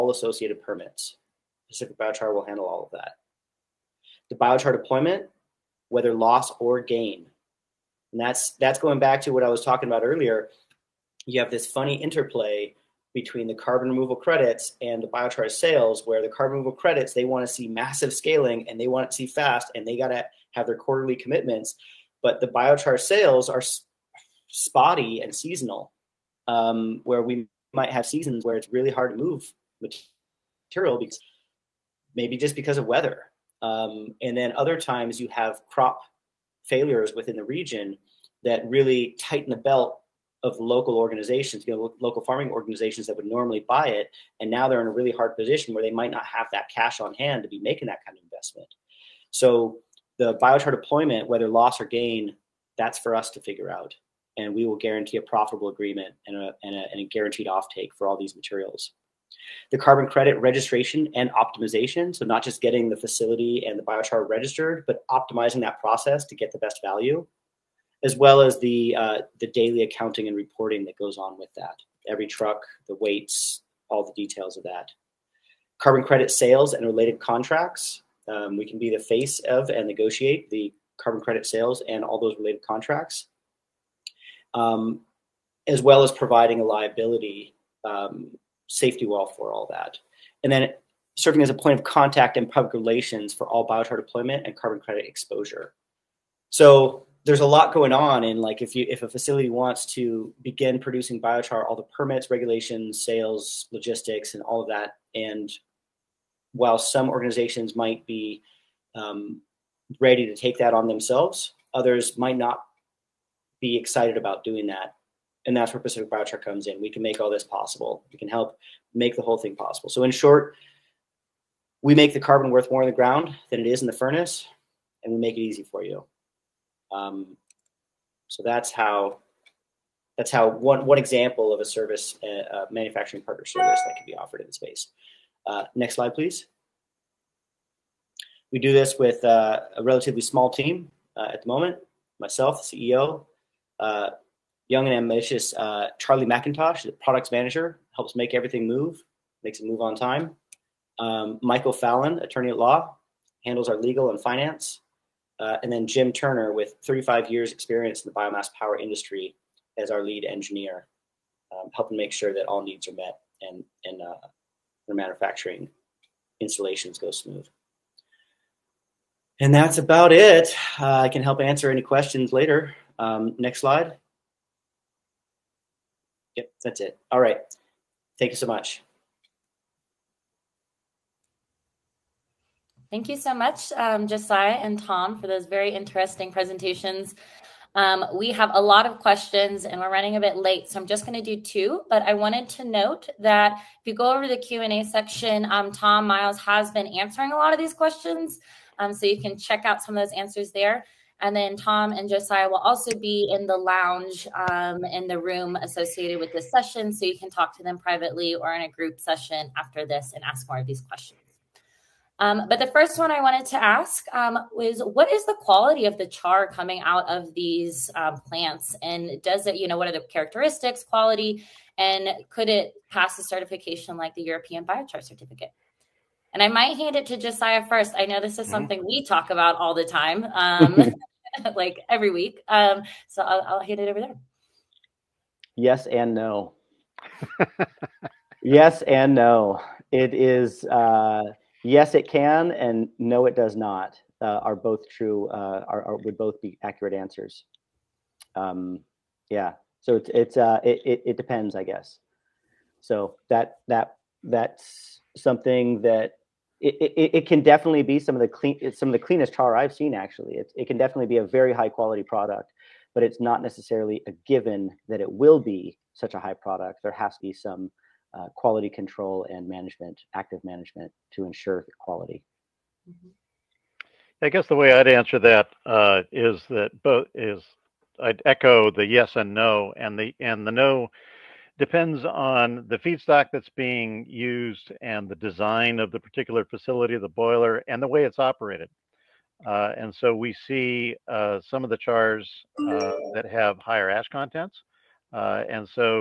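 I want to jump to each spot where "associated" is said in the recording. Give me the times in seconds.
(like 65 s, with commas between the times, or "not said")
0 s, 205 s.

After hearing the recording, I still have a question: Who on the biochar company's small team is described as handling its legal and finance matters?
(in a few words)
Michael Fallon.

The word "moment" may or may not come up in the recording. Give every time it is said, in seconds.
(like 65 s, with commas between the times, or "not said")
141 s.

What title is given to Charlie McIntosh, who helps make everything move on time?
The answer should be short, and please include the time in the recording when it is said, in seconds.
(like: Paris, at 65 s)
products manager, at 146 s.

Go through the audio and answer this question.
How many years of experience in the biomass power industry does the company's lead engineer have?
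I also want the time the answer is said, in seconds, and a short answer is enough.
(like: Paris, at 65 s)
35, at 156 s.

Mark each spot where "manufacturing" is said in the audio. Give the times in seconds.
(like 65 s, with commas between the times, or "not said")
132 s, 164 s.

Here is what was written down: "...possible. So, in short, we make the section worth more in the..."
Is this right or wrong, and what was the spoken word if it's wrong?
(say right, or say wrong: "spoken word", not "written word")
wrong: "carbon", not "section".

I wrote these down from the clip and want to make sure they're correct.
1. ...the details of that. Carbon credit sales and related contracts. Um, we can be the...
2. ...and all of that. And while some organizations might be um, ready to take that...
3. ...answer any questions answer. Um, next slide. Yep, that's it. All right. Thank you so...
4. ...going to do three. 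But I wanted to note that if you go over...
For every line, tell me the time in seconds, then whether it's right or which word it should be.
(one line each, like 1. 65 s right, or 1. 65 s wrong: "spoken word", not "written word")
1. 74 s right
2. 104 s right
3. 171 s wrong: "later", not "answer"
4. 191 s wrong: "two", not "three".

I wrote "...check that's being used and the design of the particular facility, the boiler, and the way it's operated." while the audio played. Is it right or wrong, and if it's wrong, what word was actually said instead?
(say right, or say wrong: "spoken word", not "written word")
wrong: "feedstock", not "check".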